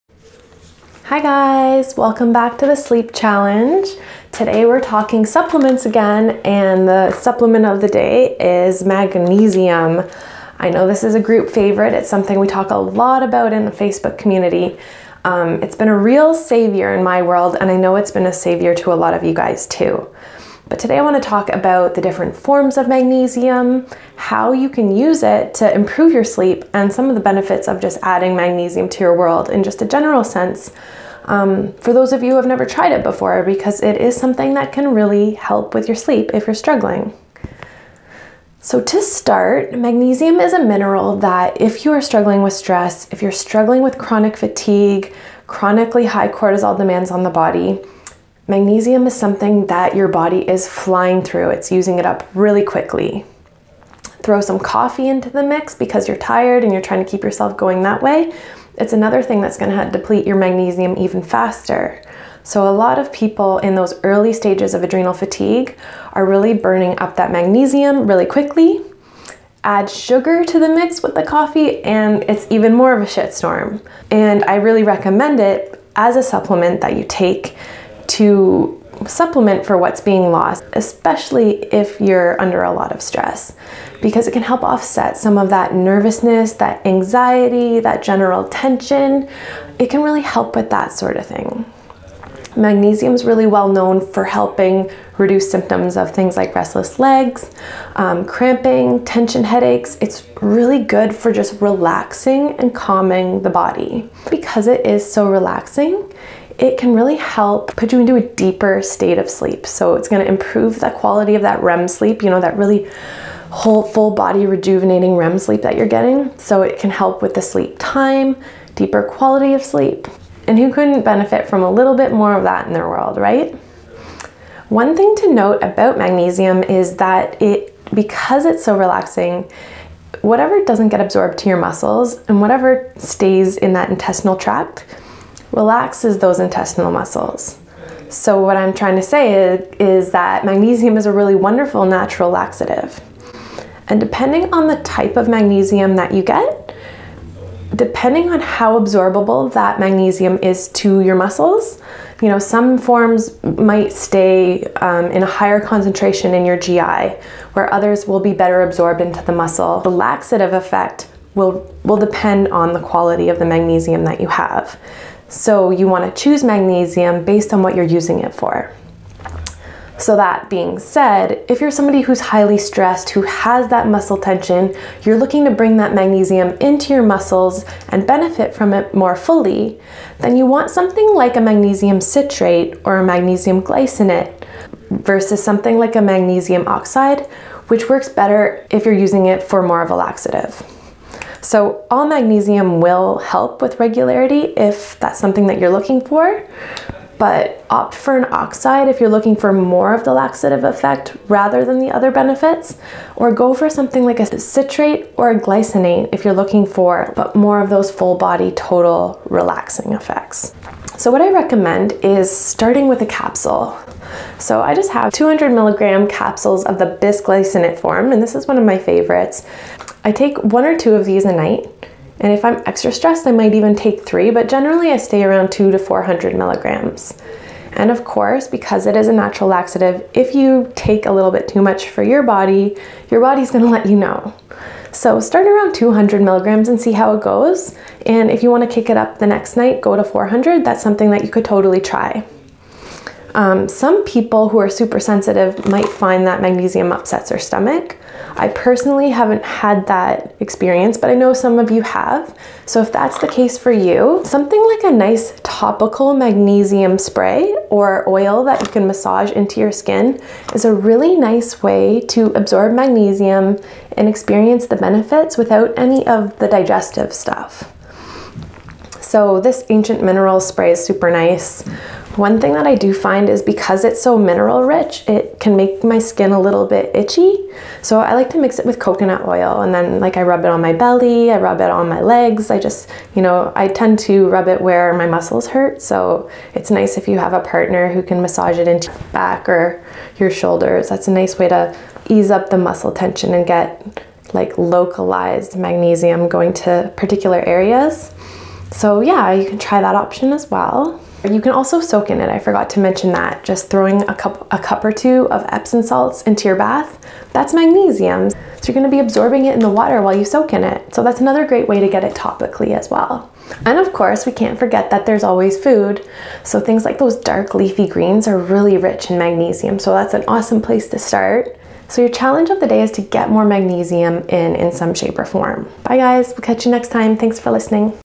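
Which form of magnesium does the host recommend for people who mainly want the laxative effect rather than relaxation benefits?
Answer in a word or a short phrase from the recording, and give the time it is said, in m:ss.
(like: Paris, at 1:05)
magnesium oxide, at 3:06.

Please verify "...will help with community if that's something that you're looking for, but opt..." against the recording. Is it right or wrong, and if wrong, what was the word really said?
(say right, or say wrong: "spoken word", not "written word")
wrong: "regularity", not "community".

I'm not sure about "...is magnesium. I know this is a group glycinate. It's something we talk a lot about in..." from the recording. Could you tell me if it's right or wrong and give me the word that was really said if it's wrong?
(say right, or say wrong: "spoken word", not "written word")
wrong: "favorite", not "glycinate".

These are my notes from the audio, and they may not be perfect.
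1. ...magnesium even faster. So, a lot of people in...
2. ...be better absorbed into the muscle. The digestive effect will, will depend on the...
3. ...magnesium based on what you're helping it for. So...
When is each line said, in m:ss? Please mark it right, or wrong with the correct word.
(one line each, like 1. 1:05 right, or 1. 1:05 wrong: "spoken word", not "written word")
1. 1:00 right
2. 2:38 wrong: "laxative", not "digestive"
3. 2:46 wrong: "using", not "helping".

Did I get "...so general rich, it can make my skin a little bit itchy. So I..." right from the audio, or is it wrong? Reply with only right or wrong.
wrong.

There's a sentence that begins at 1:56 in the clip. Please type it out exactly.
So it can help with the sleep time, deeper quality of sleep.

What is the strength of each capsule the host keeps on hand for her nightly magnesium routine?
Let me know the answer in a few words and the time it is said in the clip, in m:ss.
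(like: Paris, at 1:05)
200 milligrams, at 3:35.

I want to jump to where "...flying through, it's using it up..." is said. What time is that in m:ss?
0:50.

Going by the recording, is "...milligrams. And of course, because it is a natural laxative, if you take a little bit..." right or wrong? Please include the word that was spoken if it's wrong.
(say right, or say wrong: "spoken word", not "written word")
right.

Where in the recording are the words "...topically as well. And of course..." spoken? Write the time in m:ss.
5:12.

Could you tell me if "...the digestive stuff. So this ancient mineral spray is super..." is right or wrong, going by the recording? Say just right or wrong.
right.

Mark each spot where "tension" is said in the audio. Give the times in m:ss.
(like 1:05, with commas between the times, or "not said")
1:28, 1:39, 2:54, 4:52.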